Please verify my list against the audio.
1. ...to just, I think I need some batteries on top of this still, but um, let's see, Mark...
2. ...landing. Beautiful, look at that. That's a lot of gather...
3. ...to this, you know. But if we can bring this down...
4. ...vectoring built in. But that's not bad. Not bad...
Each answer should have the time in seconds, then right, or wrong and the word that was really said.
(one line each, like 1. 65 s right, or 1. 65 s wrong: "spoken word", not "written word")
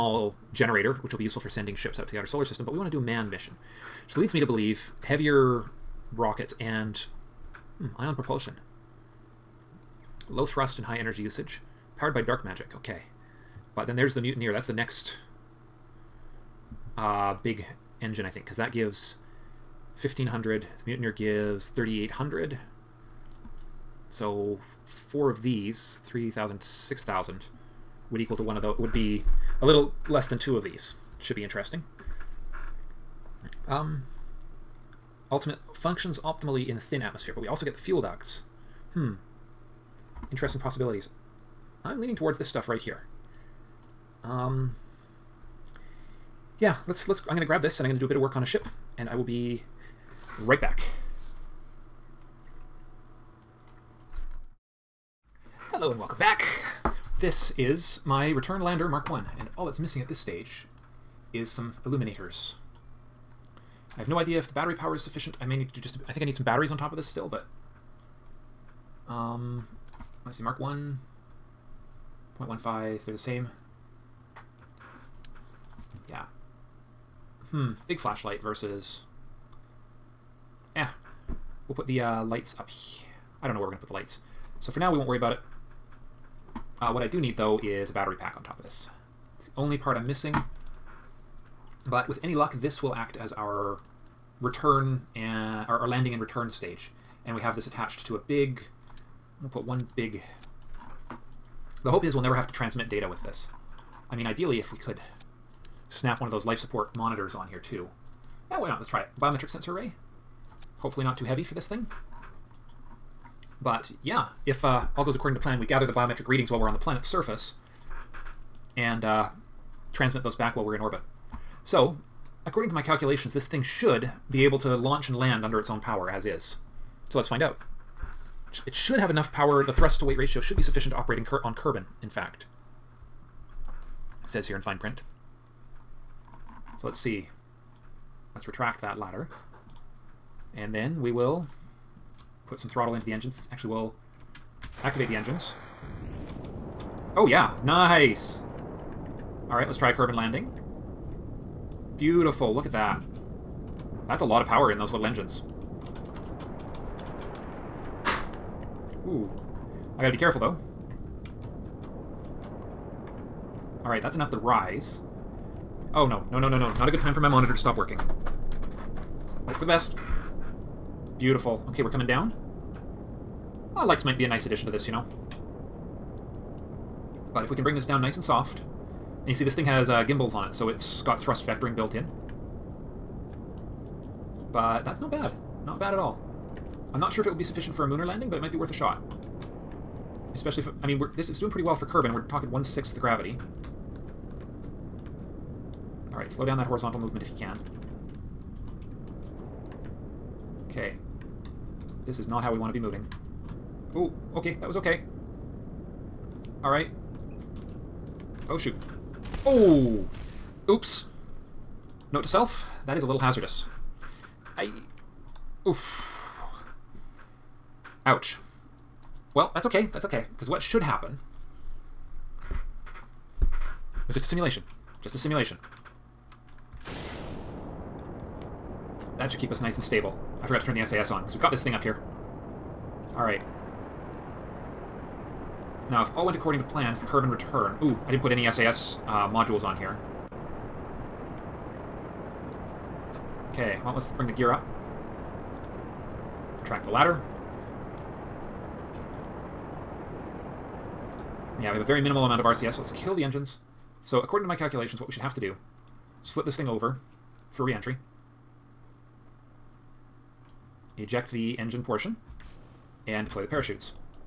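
1. 65 s right
2. 150 s wrong: "power", not "gather"
3. 174 s right
4. 181 s right.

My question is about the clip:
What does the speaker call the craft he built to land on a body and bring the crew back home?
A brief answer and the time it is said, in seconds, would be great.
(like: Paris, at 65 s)
Return lander Mark 1, at 58 s.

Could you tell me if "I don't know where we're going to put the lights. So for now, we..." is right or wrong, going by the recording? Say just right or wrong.
right.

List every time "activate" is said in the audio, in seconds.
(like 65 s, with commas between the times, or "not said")
144 s.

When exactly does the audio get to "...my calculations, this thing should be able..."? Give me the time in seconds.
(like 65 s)
122 s.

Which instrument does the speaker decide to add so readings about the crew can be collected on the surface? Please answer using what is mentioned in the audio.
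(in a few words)
Biometric sensor array.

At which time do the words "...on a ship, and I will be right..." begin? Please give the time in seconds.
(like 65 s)
48 s.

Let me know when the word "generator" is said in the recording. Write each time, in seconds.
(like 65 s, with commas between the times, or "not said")
0 s.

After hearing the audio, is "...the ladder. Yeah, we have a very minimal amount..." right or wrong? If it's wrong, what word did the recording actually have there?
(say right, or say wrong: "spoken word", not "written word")
right.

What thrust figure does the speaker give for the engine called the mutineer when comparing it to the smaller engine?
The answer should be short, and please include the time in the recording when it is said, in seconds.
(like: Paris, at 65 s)
3800, at 21 s.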